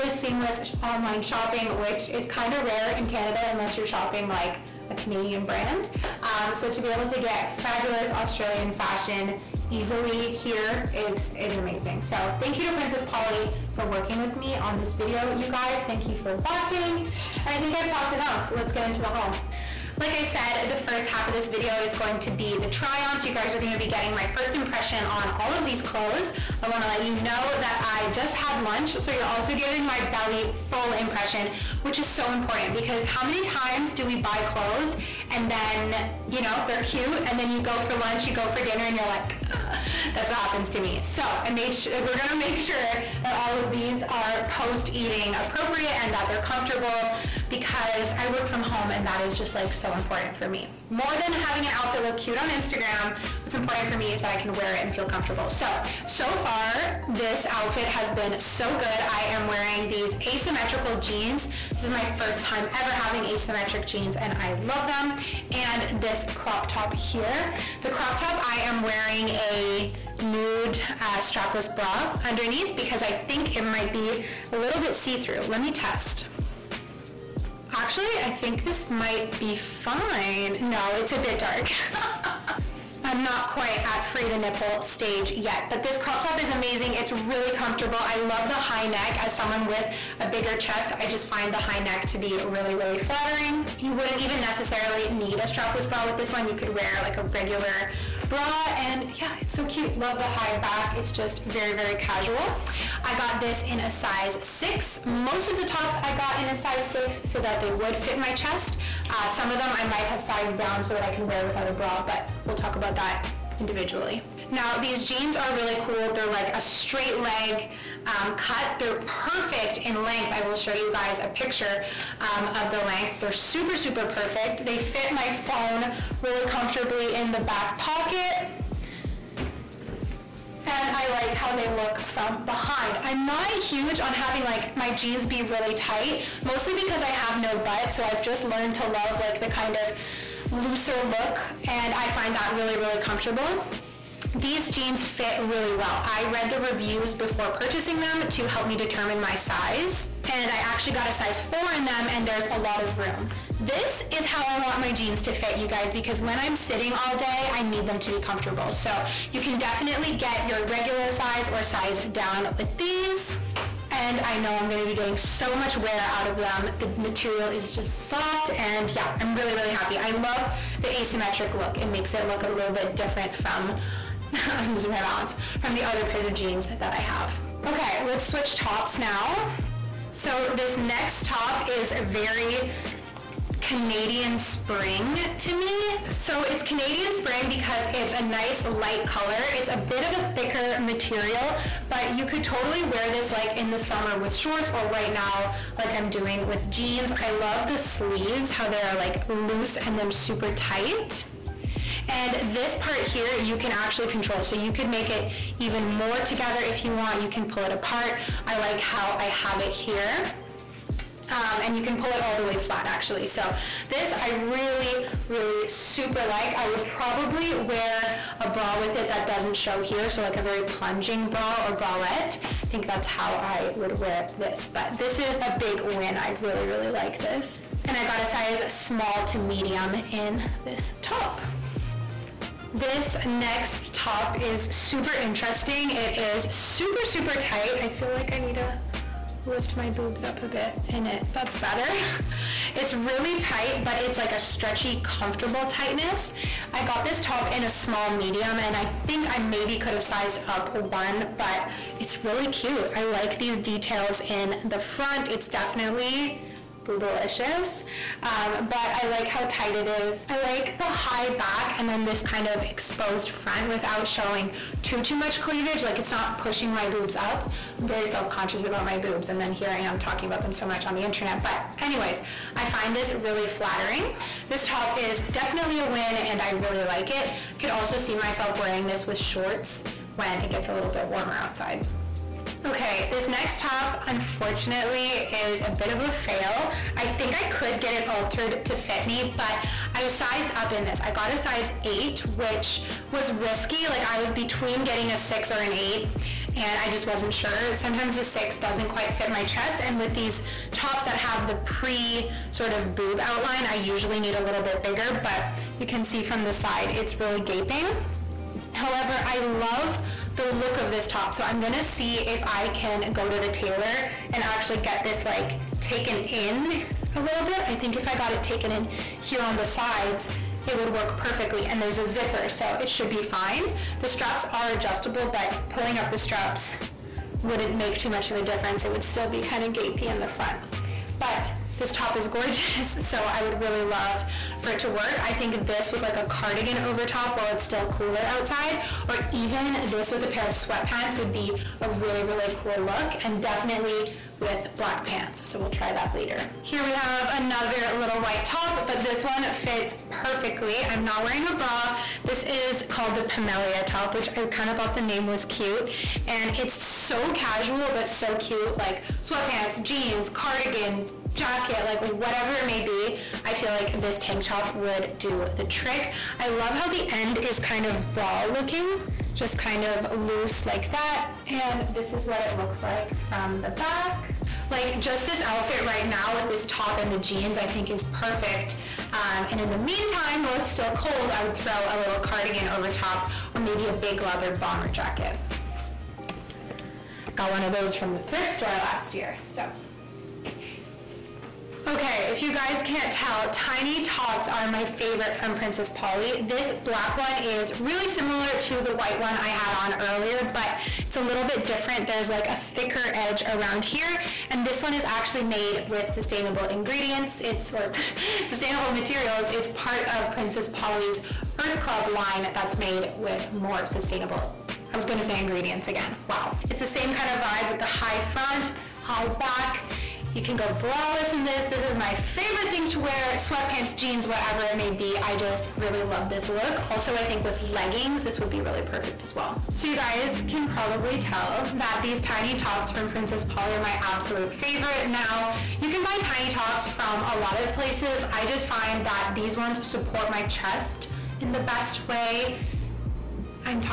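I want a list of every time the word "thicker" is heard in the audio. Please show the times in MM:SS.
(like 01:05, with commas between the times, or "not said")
03:10, 06:42.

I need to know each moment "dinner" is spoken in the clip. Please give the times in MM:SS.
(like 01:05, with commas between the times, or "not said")
00:38.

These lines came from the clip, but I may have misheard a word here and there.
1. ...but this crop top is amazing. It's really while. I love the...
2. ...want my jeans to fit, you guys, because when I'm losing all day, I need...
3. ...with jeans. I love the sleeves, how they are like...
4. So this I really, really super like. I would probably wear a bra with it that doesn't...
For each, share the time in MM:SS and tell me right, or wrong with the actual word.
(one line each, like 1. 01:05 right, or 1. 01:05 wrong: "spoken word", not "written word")
1. 01:25 wrong: "comfortable", not "while"
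2. 02:34 wrong: "sitting", not "losing"
3. 03:16 right
4. 03:33 right.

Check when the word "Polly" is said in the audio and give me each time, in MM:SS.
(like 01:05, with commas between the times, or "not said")
00:13, 06:35, 06:50, 07:13.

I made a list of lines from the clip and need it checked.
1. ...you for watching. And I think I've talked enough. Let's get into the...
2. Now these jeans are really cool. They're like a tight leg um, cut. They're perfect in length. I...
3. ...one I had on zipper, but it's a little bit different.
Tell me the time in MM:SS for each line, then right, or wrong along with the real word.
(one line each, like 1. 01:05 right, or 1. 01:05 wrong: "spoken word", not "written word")
1. 00:16 right
2. 01:54 wrong: "straight", not "tight"
3. 06:39 wrong: "earlier", not "zipper".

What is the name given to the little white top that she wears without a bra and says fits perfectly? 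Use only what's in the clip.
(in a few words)
Pamelia top.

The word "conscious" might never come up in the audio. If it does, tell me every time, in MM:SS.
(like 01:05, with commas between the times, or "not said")
04:28.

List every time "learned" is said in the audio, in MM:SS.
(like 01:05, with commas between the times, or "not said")
02:18.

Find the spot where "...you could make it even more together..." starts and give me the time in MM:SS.
03:24.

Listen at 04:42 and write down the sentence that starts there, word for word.
Okay, this next top, unfortunately, is a bit of a fail.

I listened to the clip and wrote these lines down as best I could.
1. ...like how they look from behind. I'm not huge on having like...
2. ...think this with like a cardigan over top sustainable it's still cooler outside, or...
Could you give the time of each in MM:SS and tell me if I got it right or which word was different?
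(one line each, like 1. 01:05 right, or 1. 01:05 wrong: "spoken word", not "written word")
1. 02:11 right
2. 05:35 wrong: "while", not "sustainable".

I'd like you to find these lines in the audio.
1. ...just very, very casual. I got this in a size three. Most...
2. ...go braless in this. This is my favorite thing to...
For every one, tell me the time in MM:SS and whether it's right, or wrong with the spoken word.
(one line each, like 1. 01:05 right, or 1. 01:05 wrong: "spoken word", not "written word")
1. 01:41 wrong: "six", not "three"
2. 07:00 right.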